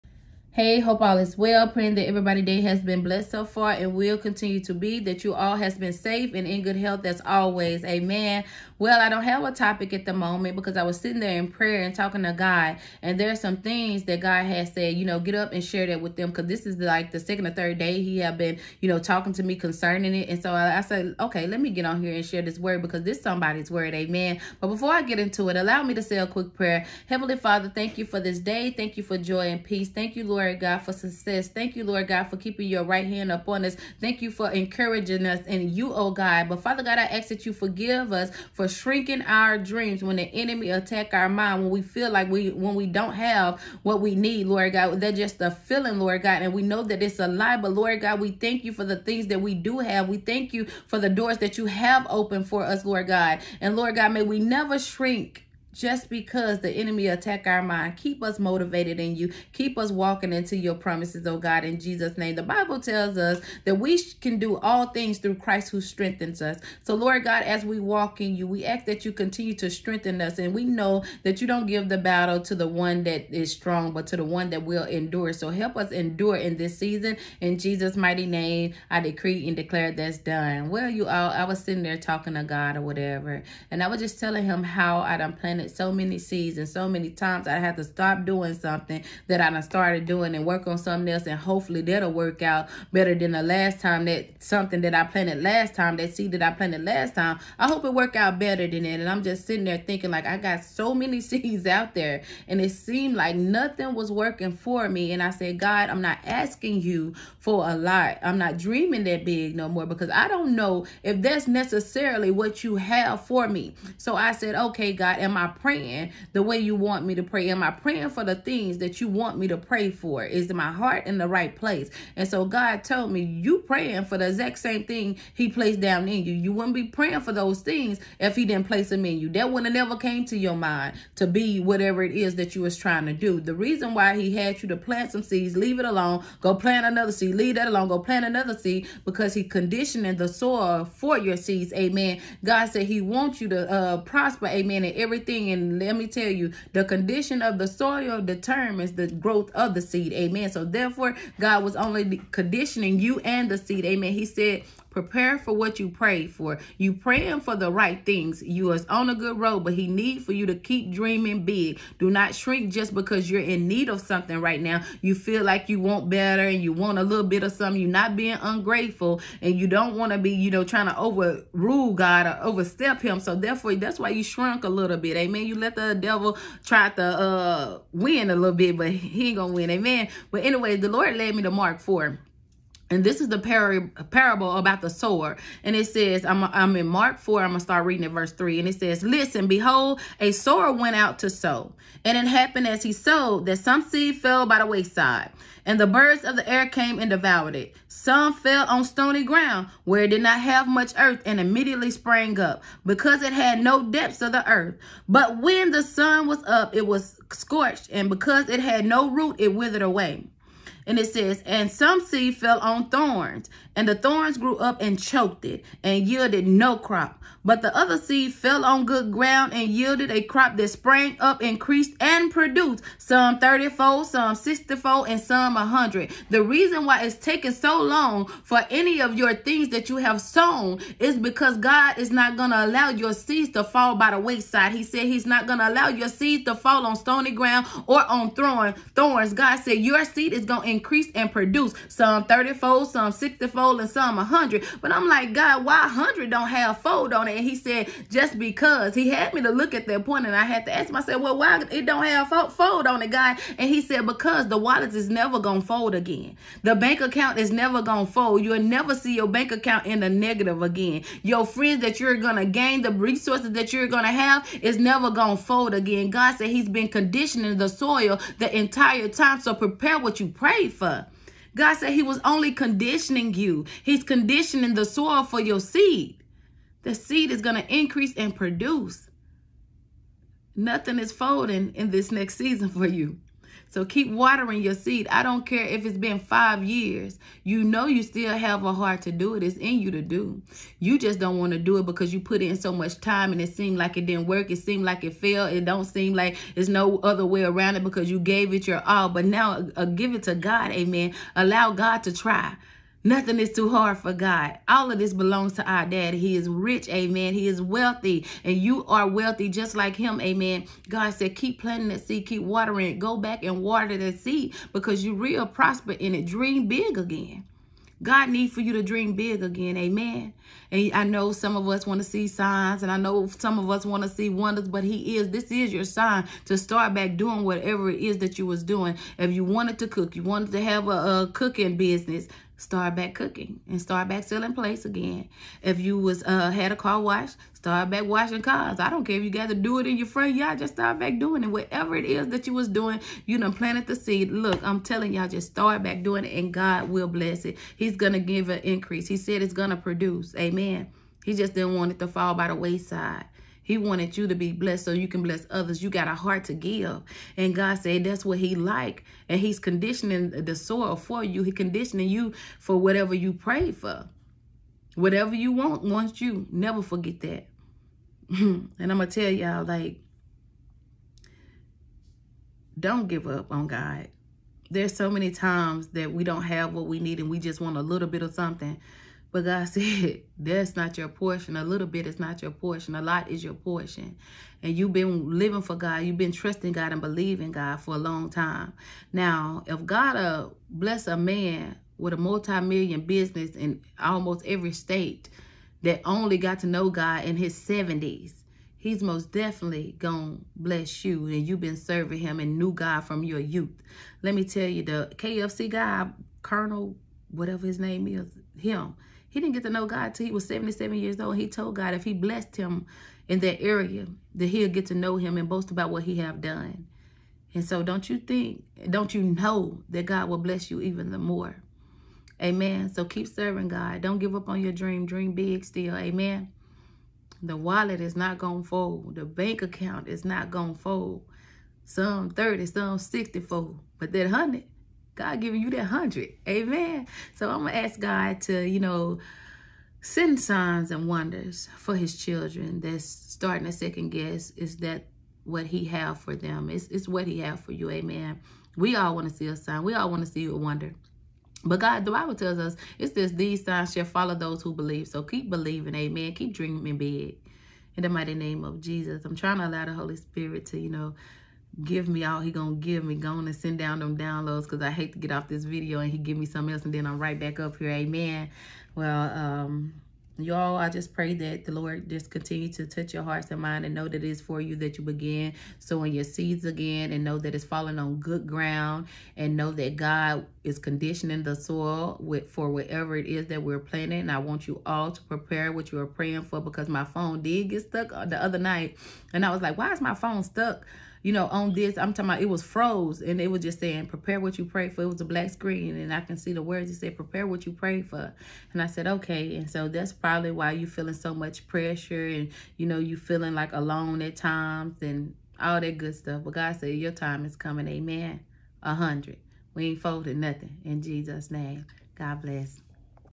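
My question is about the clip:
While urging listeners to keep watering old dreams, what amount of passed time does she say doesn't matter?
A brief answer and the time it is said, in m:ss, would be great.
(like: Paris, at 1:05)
Five years, at 4:46.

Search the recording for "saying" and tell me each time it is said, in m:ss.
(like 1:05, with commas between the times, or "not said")
8:13.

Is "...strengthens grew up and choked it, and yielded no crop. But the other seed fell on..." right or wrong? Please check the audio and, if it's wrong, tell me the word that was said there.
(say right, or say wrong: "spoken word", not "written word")
wrong: "thorns", not "strengthens".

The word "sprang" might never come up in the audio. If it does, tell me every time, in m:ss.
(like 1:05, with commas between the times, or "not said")
3:21, 3:40.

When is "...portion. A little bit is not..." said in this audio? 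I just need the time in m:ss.
6:21.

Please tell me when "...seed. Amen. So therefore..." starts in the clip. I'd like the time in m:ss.
2:29.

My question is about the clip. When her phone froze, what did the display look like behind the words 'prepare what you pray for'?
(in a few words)
Black screen.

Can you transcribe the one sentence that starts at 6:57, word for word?
And so don't you think, don't you know that God will bless you even the more?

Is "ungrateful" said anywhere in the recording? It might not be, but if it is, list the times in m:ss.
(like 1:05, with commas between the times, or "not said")
2:48.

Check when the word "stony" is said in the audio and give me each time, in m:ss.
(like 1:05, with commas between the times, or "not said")
3:18, 3:56.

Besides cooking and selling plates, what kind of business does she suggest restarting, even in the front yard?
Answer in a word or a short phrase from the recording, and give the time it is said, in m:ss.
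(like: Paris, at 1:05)
Car wash, at 5:36.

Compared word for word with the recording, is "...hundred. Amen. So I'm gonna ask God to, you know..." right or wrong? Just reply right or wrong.
right.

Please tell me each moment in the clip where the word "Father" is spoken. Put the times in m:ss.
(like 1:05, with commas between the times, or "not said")
0:27, 0:36.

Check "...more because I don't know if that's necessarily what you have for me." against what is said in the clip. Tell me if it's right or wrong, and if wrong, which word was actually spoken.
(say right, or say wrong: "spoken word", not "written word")
right.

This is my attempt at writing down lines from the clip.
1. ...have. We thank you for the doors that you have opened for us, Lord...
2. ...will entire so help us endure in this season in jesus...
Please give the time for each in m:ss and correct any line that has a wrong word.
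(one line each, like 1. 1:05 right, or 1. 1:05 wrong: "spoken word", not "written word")
1. 0:49 right
2. 1:14 wrong: "endure", not "entire".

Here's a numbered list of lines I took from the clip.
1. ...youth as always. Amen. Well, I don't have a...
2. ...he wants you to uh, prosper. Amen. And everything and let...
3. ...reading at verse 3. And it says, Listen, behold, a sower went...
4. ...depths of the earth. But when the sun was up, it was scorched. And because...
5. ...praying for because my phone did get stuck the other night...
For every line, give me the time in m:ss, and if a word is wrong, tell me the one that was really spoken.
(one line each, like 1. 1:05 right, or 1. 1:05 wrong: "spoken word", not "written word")
1. 0:06 wrong: "health", not "youth"
2. 2:22 right
3. 3:07 right
4. 3:23 right
5. 8:06 right.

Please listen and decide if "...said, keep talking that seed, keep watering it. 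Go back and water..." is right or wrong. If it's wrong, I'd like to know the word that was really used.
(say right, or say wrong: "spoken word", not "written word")
wrong: "planting", not "talking".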